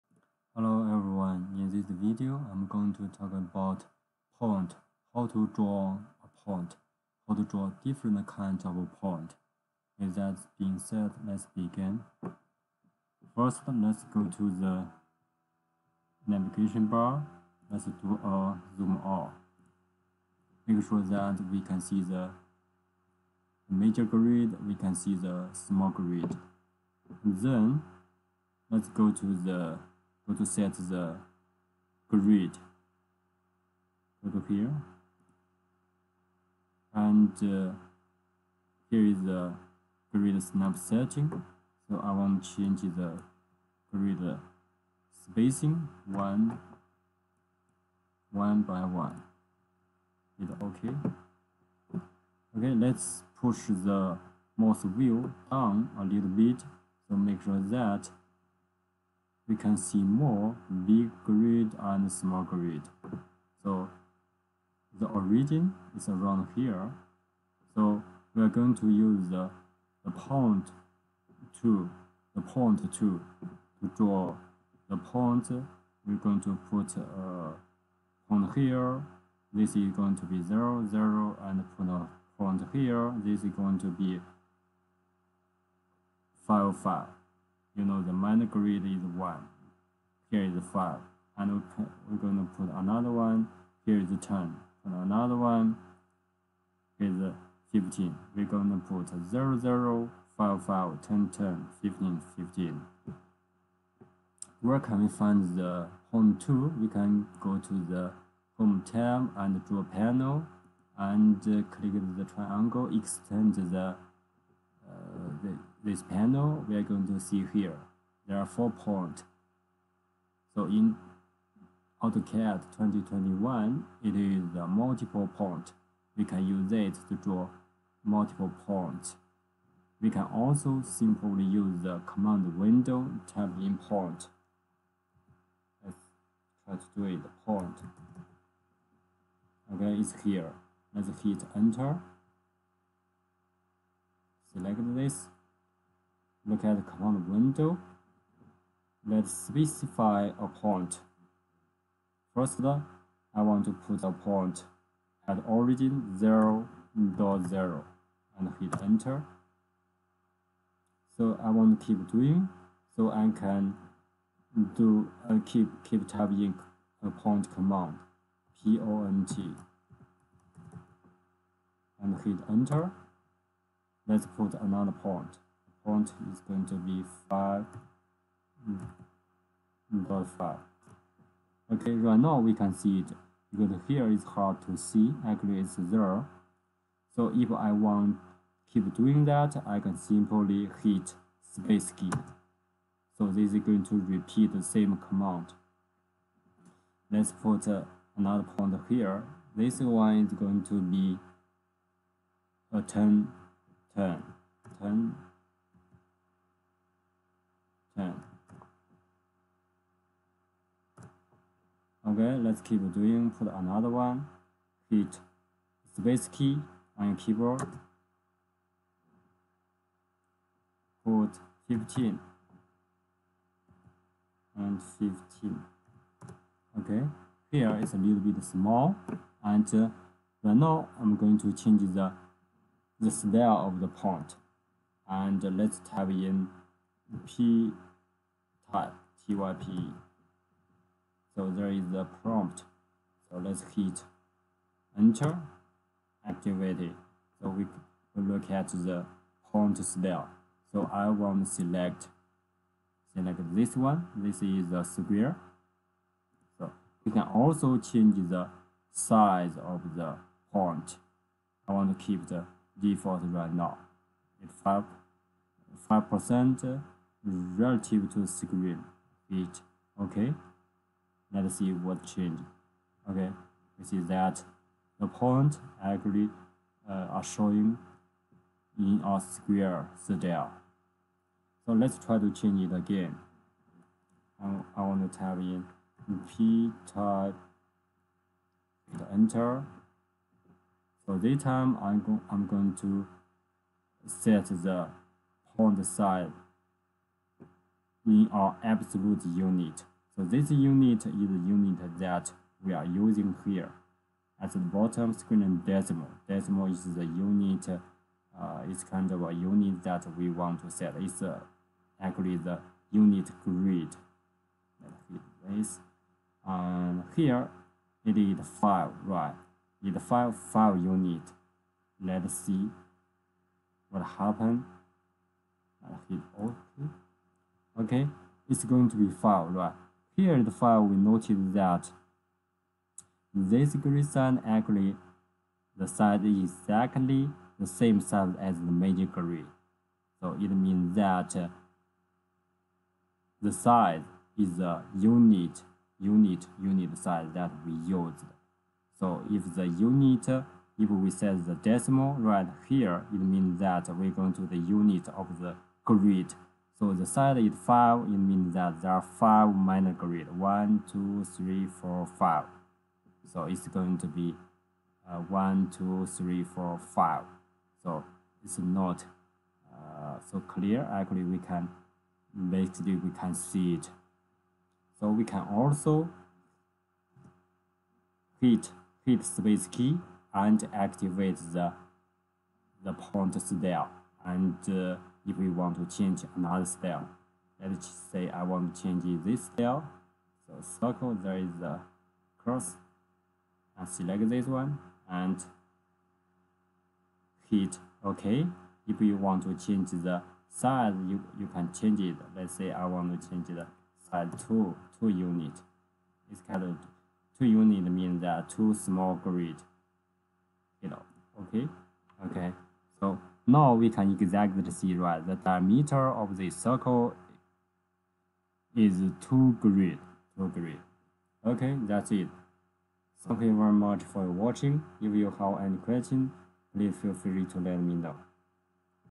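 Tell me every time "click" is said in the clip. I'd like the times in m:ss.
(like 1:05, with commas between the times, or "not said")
1:51.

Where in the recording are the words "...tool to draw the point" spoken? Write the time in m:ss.
1:12.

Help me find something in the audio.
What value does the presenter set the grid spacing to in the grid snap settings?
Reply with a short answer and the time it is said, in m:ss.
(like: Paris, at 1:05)
1 by 1, at 0:46.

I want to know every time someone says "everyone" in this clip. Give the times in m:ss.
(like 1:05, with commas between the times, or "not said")
0:01.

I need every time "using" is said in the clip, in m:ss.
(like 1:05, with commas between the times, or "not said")
5:02.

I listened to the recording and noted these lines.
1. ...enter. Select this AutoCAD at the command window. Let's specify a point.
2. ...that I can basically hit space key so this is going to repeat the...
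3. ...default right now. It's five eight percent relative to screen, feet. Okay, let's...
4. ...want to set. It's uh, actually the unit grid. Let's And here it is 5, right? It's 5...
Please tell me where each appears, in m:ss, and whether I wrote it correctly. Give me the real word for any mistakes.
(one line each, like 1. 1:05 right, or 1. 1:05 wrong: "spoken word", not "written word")
1. 2:21 wrong: "Look", not "AutoCAD"
2. 3:09 wrong: "simply", not "basically"
3. 4:22 wrong: "five", not "eight"
4. 5:10 right.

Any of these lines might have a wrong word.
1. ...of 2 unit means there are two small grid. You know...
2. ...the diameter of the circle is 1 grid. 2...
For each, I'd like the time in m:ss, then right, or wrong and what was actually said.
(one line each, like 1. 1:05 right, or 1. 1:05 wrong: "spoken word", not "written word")
1. 6:46 right
2. 6:55 wrong: "2", not "1".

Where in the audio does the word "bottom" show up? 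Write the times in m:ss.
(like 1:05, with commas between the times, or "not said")
5:04.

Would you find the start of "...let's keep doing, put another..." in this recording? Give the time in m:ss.
3:32.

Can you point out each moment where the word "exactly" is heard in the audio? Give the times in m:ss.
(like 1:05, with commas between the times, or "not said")
5:36, 6:54.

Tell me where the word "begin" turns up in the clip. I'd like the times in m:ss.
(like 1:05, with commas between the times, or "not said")
0:11.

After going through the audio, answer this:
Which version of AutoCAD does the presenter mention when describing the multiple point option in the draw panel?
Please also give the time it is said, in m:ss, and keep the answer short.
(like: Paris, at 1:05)
AutoCAD 2021, at 2:02.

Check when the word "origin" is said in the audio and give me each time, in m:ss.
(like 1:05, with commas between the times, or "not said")
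1:05, 2:35.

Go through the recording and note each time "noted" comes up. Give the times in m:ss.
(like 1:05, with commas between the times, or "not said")
5:30.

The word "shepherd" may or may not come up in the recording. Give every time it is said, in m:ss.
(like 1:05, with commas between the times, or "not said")
not said.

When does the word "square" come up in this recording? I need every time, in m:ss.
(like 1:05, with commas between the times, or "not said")
4:14, 4:39.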